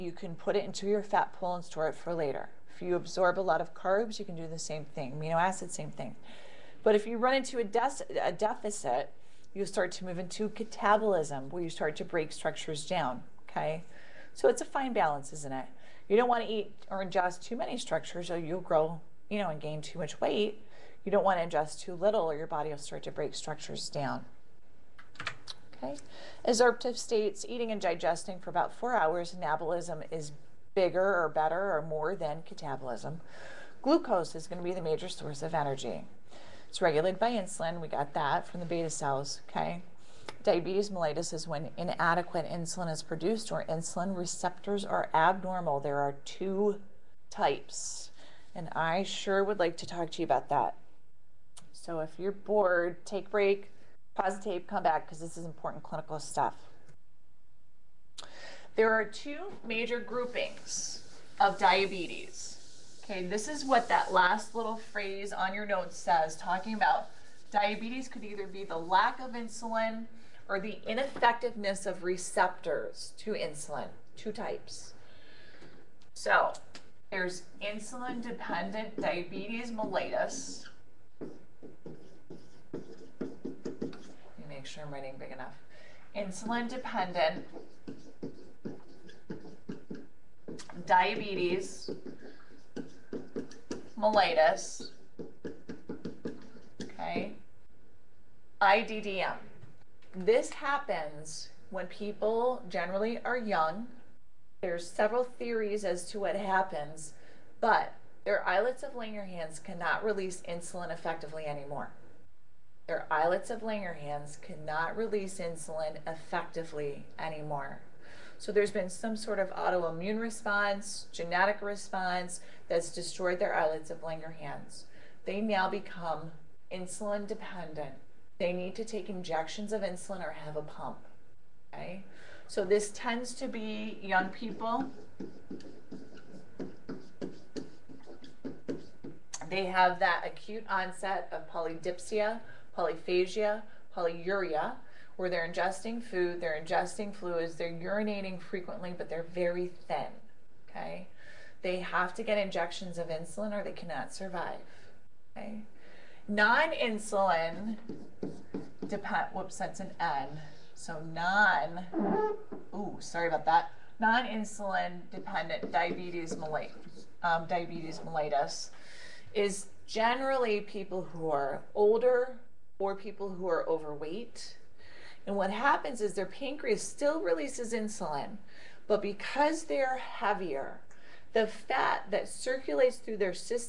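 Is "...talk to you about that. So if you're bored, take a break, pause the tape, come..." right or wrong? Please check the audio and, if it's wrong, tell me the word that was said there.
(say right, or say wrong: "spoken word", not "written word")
right.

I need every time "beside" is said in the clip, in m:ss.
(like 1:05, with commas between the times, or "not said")
not said.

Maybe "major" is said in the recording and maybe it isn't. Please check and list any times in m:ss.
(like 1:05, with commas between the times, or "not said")
0:34, 0:59.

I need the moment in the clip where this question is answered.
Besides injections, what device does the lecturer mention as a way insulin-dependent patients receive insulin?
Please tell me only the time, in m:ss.
2:10.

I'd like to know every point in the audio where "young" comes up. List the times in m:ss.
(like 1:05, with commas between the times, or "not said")
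1:43, 2:14.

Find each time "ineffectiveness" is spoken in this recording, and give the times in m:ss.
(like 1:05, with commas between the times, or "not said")
1:10.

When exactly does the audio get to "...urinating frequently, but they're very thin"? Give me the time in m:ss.
2:27.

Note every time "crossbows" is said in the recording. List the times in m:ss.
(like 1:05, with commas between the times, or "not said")
not said.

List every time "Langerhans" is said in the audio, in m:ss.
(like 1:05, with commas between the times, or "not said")
1:48, 1:53, 2:04.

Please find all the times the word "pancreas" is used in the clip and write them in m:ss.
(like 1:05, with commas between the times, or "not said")
2:56.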